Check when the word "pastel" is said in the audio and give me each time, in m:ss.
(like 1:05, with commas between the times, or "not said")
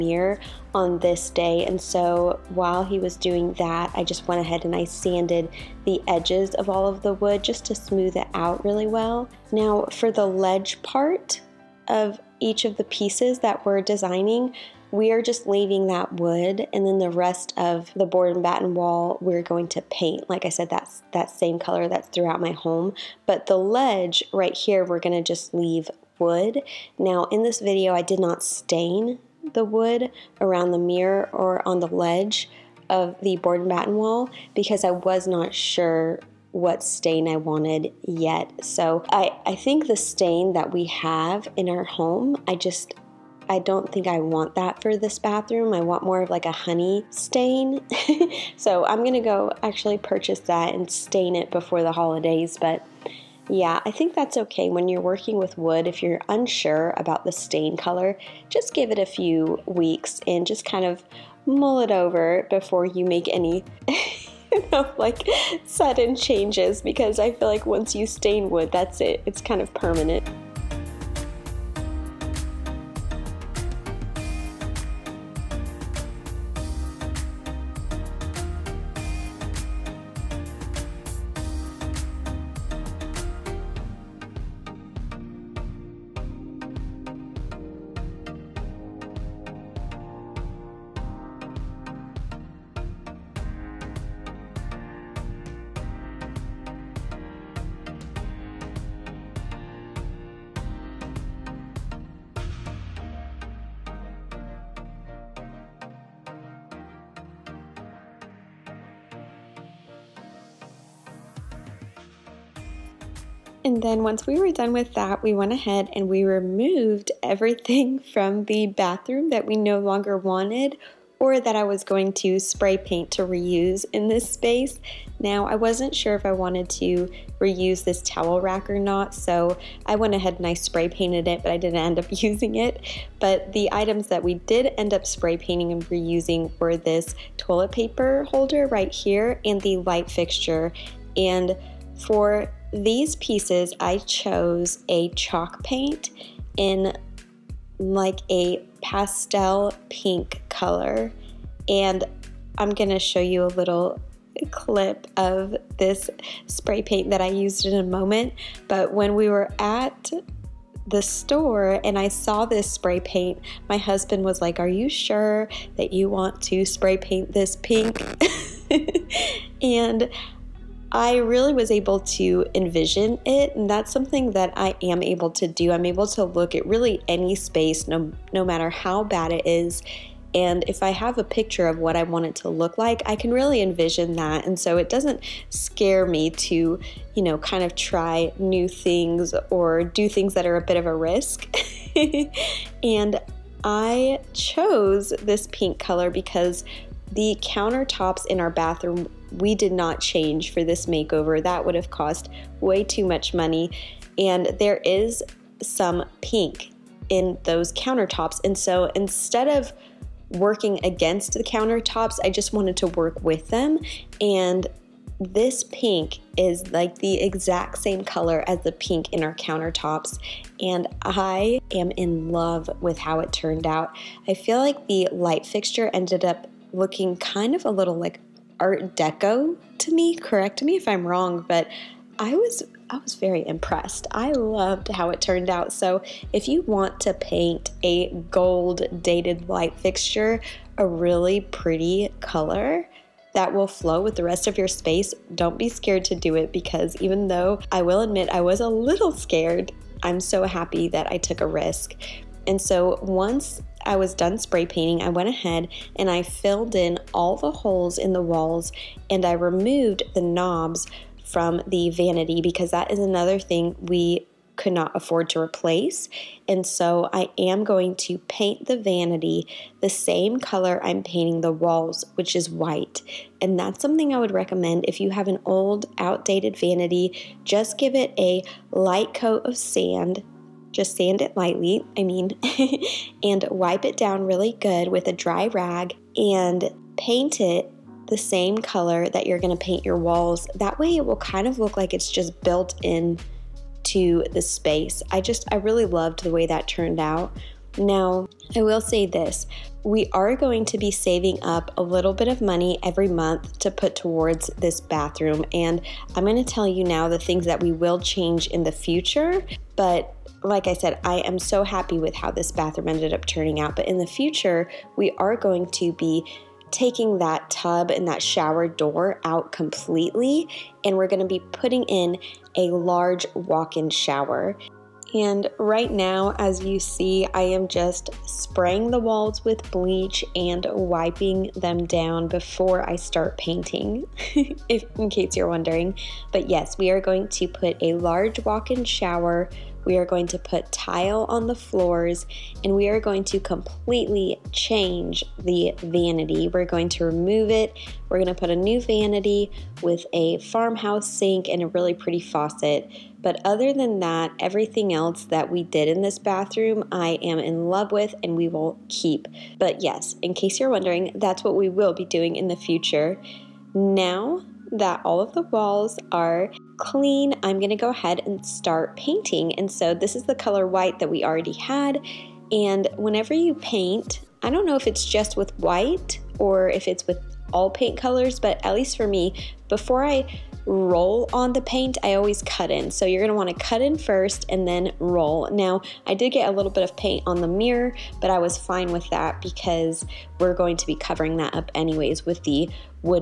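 2:28.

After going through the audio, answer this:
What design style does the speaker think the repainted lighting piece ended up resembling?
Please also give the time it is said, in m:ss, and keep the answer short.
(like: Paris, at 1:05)
Art Deco, at 3:48.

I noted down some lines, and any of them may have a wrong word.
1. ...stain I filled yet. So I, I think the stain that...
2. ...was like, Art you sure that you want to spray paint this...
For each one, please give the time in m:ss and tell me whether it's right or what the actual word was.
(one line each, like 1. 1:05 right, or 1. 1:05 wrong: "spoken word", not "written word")
1. 0:36 wrong: "wanted", not "filled"
2. 2:44 wrong: "Are", not "Art".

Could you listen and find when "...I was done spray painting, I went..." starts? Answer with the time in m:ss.
4:13.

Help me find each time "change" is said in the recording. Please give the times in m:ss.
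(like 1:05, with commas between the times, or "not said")
1:06, 3:20, 5:07, 5:44.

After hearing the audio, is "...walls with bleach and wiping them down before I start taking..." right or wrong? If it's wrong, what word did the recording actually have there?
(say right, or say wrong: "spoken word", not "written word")
wrong: "painting", not "taking".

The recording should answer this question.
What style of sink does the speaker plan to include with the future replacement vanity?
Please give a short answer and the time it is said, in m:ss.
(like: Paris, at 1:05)
farmhouse sink, at 5:50.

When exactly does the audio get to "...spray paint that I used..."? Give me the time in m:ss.
2:36.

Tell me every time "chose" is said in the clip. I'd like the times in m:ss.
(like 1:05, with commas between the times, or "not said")
2:23, 3:14.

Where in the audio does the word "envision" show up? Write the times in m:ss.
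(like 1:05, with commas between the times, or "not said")
2:52, 3:03.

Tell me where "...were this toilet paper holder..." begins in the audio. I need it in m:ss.
2:16.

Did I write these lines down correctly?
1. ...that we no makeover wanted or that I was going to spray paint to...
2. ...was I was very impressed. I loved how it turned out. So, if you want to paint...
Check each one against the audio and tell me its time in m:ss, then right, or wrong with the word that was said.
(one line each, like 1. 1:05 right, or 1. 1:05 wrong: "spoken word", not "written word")
1. 1:59 wrong: "longer", not "makeover"
2. 3:52 right.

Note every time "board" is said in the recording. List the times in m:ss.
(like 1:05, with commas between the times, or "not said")
0:18, 0:33.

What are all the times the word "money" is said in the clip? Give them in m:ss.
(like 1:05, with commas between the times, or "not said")
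3:23, 5:02.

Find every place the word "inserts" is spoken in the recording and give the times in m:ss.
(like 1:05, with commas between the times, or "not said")
not said.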